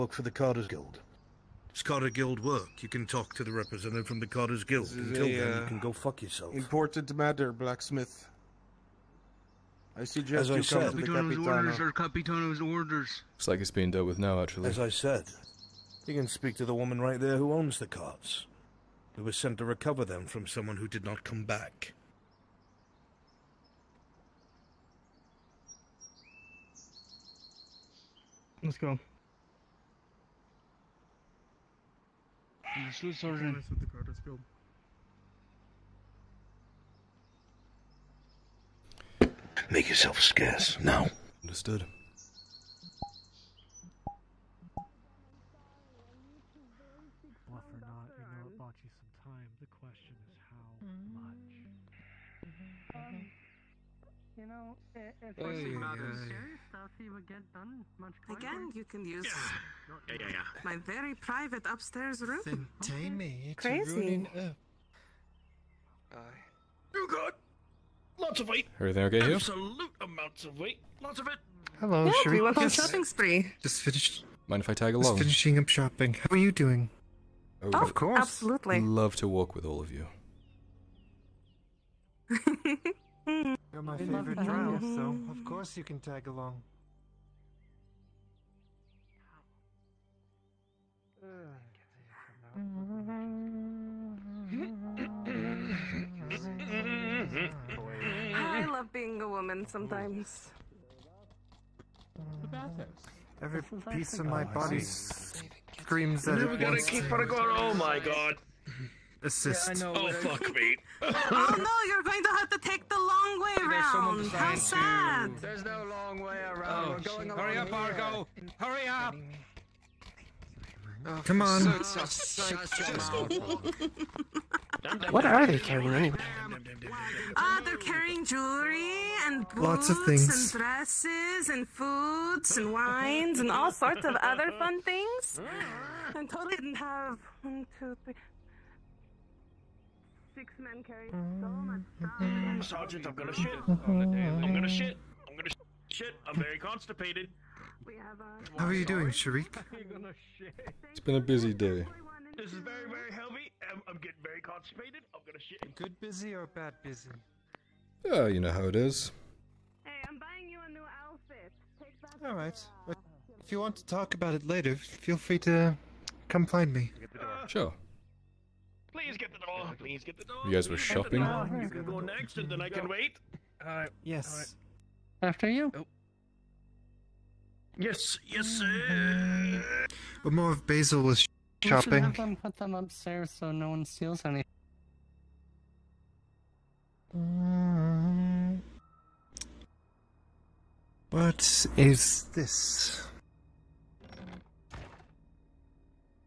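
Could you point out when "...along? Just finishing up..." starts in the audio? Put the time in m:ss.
1:14.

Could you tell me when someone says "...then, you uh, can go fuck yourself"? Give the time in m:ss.
0:05.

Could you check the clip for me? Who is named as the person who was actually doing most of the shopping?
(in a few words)
Basil.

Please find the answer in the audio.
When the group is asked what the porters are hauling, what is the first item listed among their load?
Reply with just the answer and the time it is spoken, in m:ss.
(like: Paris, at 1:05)
Jewelry, at 2:08.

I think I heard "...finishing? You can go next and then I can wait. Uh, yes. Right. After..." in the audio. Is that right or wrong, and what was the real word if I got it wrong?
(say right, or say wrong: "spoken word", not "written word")
wrong: "shopping", not "finishing".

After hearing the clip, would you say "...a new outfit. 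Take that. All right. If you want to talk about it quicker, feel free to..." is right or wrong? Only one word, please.
wrong.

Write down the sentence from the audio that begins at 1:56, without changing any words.
Oh, We're going Hurry up, Argo.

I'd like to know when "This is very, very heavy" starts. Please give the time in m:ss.
2:32.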